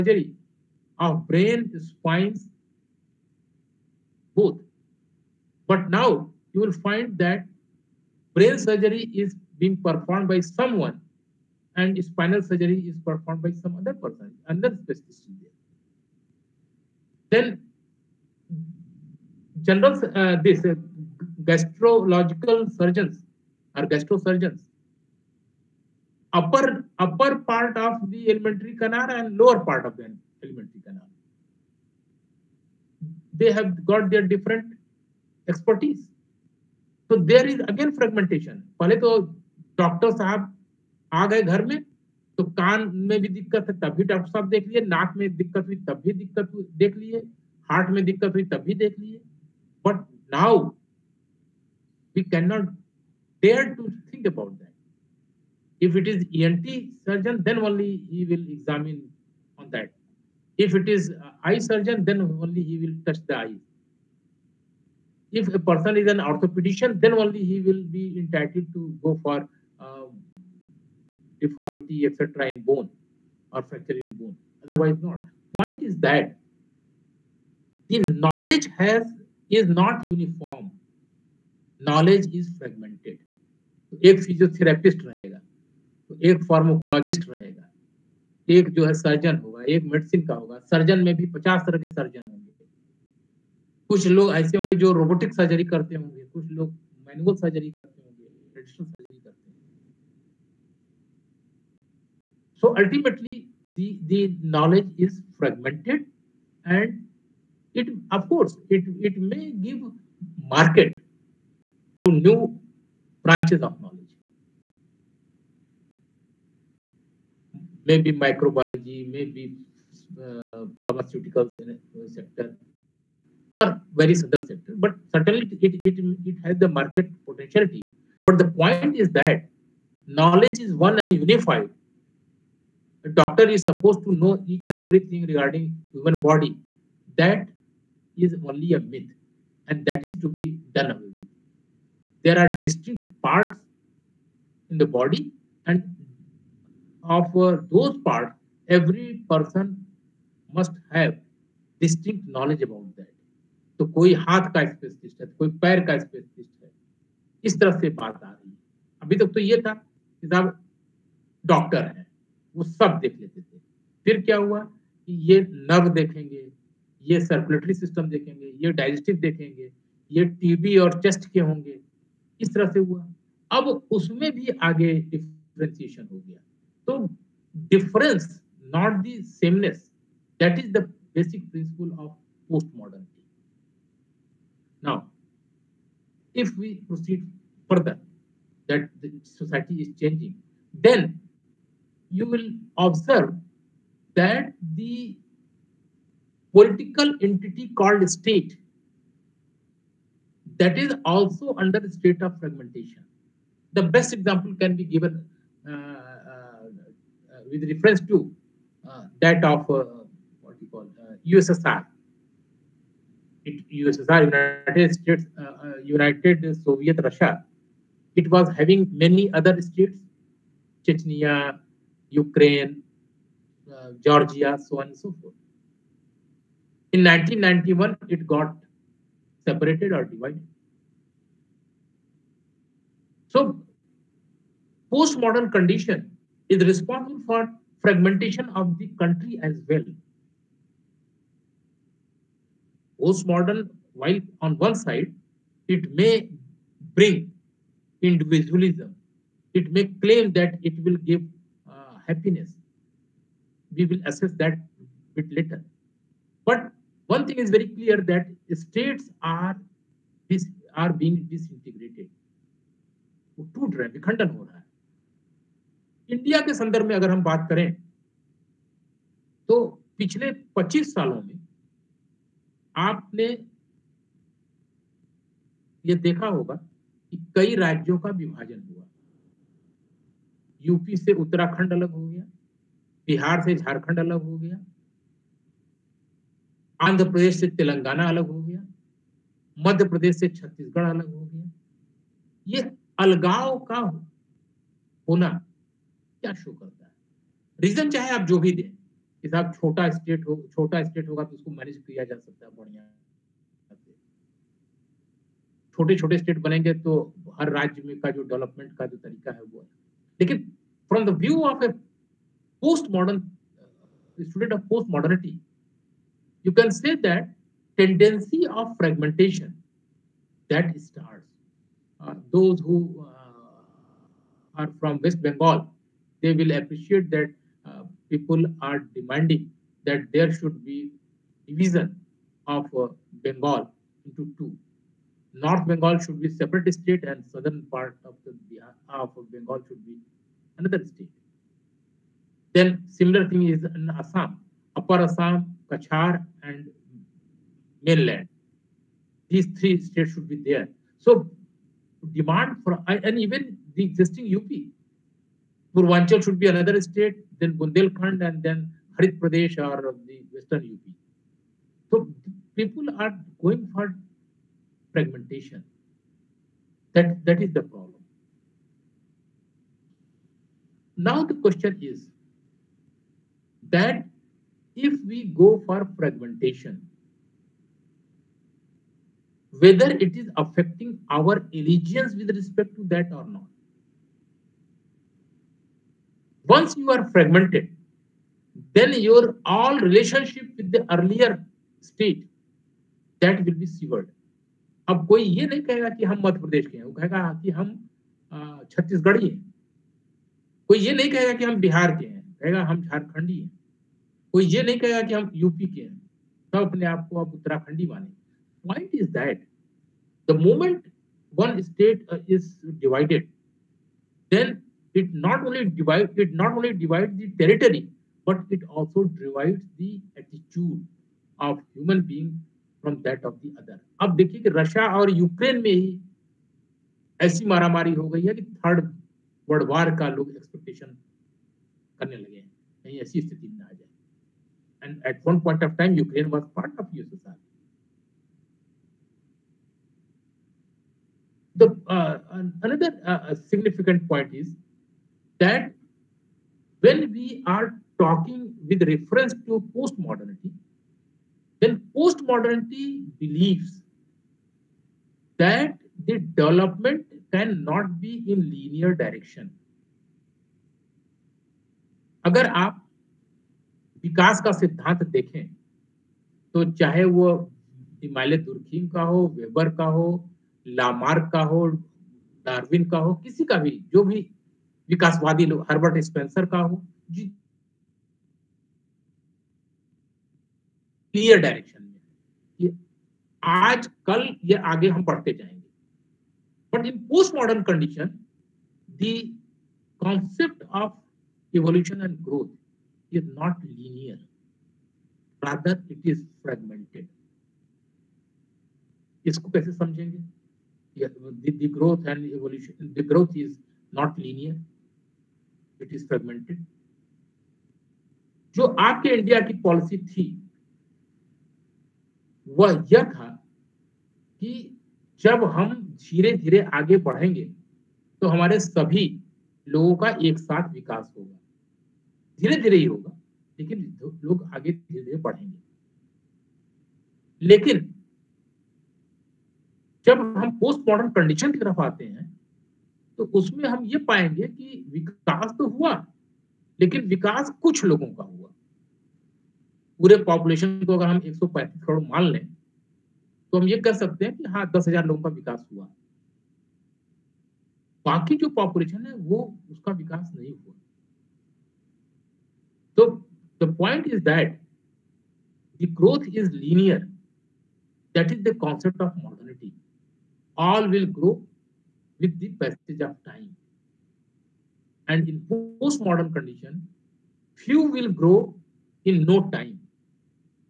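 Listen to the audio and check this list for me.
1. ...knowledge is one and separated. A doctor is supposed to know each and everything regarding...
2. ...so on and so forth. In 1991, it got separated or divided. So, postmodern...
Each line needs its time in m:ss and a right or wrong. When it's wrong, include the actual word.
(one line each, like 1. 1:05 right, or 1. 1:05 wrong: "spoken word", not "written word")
1. 2:10 wrong: "unified", not "separated"
2. 3:44 right.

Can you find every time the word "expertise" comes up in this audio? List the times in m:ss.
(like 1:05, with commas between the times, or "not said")
0:35.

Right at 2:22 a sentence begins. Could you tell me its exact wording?
There are distinct parts in the body, and of those parts, every person must have distinct knowledge about that.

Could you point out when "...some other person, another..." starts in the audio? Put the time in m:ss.
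0:13.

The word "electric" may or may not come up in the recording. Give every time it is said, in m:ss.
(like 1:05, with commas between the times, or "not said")
not said.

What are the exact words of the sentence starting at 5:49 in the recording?
These three states should be there.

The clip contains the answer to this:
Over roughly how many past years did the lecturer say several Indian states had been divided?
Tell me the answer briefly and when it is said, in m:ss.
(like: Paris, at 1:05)
25, at 4:30.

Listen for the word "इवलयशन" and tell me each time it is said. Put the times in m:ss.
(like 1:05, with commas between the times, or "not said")
8:11, 8:22.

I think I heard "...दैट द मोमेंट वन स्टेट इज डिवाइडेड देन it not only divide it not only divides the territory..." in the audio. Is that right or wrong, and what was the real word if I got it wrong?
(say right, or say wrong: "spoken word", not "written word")
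right.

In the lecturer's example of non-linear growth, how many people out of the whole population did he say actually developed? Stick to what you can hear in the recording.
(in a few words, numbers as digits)
10,000.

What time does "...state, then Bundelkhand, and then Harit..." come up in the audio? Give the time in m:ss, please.
5:56.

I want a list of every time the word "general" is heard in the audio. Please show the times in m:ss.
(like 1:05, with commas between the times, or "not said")
0:19.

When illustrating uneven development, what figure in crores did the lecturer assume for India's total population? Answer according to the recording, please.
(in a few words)
135 crore.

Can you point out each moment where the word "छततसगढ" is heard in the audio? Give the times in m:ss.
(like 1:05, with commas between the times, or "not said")
4:50, 6:38.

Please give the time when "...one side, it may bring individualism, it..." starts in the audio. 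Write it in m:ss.
4:04.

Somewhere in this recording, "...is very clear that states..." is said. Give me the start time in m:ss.
4:17.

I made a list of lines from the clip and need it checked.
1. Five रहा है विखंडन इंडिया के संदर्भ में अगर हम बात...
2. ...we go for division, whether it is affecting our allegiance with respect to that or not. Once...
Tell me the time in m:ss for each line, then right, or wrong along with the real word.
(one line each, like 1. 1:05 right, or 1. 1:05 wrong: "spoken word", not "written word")
1. 4:23 wrong: "Two", not "Five"
2. 6:15 wrong: "fragmentation", not "division".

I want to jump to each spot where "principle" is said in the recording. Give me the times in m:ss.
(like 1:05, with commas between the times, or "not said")
3:01.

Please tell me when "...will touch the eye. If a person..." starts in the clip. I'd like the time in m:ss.
1:02.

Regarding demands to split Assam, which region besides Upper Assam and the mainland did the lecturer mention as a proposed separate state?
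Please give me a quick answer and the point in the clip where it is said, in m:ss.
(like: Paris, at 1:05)
Cachar, at 5:45.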